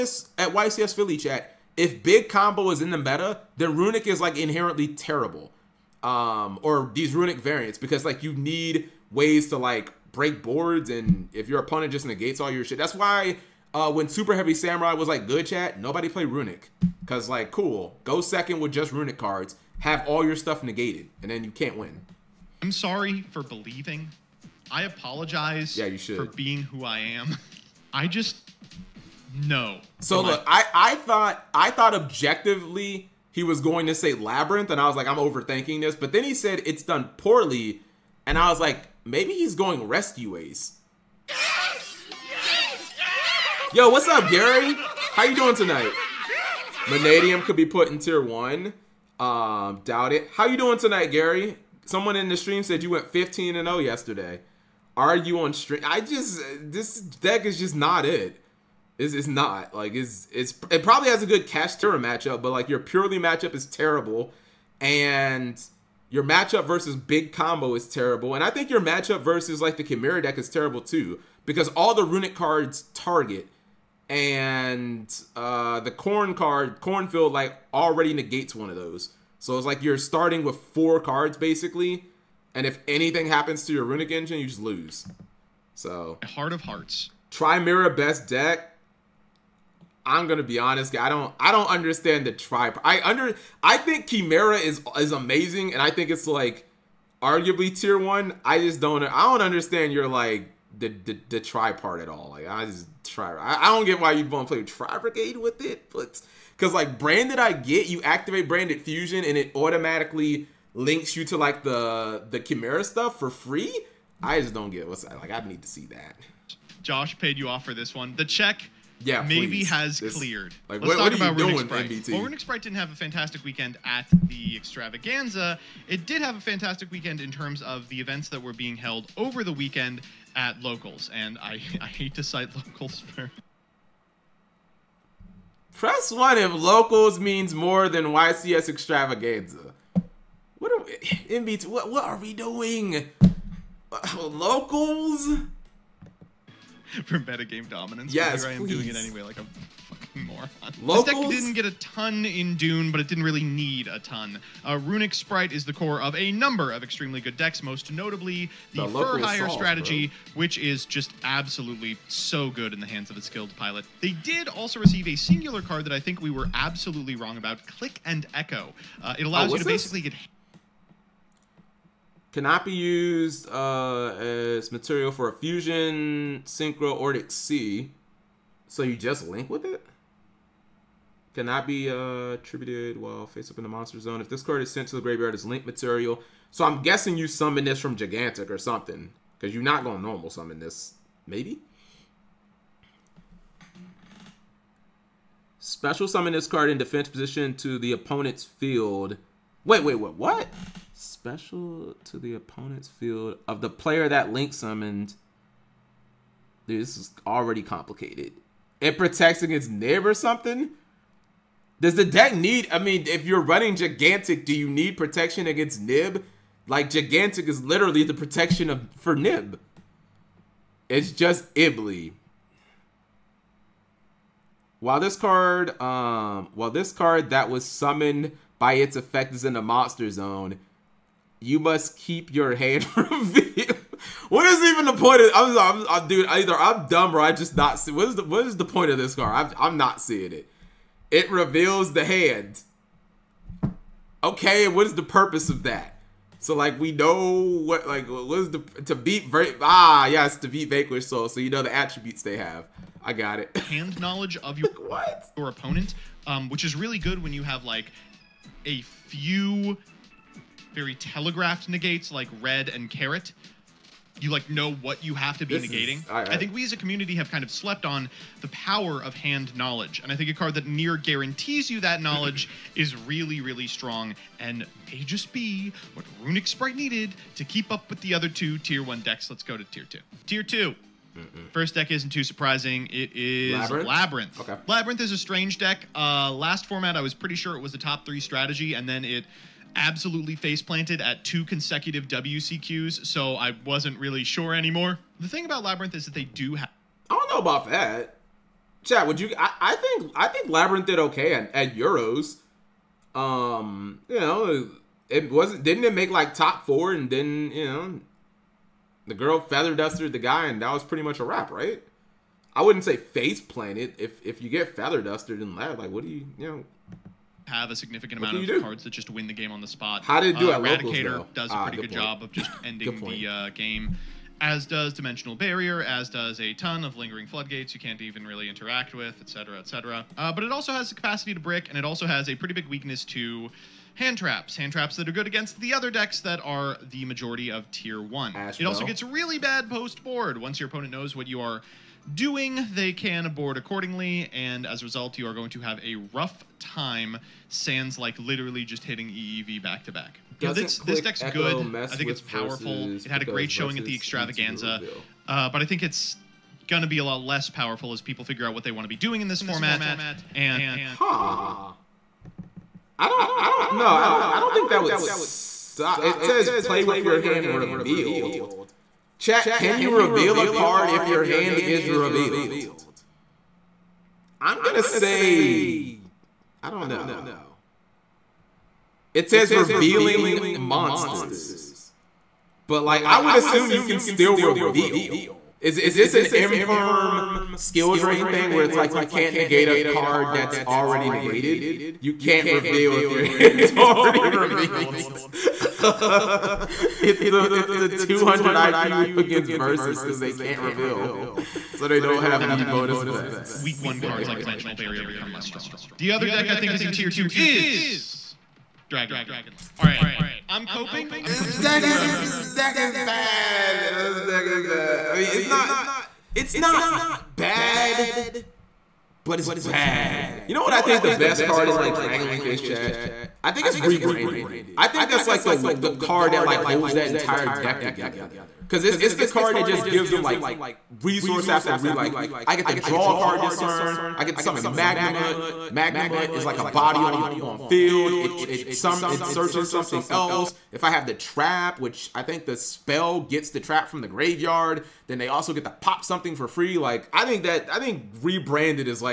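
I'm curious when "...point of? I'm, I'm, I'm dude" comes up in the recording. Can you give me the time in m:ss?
3:54.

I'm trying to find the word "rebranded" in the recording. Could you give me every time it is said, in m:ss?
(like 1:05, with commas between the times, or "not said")
7:03, 7:28.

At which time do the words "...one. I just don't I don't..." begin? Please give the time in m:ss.
1:37.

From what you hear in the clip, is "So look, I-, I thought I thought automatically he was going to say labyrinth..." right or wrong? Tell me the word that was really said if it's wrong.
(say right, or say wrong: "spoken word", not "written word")
wrong: "objectively", not "automatically".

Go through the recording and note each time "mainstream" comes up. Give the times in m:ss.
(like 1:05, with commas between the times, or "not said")
not said.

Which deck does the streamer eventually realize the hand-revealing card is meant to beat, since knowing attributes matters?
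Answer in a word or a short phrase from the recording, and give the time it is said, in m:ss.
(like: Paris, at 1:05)
Vanquish Soul, at 4:10.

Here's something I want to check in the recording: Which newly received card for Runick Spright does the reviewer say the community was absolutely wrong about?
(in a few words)
Click and Echo.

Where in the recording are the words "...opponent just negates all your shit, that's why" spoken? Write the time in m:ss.
0:11.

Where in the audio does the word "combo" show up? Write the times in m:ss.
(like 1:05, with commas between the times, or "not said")
0:02, 1:07.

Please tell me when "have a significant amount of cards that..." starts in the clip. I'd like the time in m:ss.
5:17.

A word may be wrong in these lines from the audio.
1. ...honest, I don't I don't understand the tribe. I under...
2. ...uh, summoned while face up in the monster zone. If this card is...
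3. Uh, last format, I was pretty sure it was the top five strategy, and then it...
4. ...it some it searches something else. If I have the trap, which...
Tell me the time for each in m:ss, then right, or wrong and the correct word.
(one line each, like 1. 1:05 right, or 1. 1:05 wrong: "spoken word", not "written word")
1. 1:30 right
2. 3:01 wrong: "attributed", not "summoned"
3. 4:45 wrong: "three", not "five"
4. 7:18 right.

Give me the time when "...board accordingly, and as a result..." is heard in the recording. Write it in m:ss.
5:43.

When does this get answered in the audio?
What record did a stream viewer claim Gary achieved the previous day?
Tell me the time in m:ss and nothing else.
0:53.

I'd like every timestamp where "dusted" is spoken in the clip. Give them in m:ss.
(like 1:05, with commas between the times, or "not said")
5:09, 5:15.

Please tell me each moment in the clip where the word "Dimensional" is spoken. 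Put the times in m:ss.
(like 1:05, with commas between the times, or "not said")
5:24, 6:44.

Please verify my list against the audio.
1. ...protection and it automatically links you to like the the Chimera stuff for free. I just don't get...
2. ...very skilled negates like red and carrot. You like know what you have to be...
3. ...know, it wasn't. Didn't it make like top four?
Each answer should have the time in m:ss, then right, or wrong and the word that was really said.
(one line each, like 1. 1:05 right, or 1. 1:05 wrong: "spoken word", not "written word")
1. 1:48 wrong: "fusion", not "protection"
2. 4:20 wrong: "telegraphed", not "skilled"
3. 5:04 right.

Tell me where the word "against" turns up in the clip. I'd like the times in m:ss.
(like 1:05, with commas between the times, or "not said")
3:29, 3:35, 5:35, 6:39.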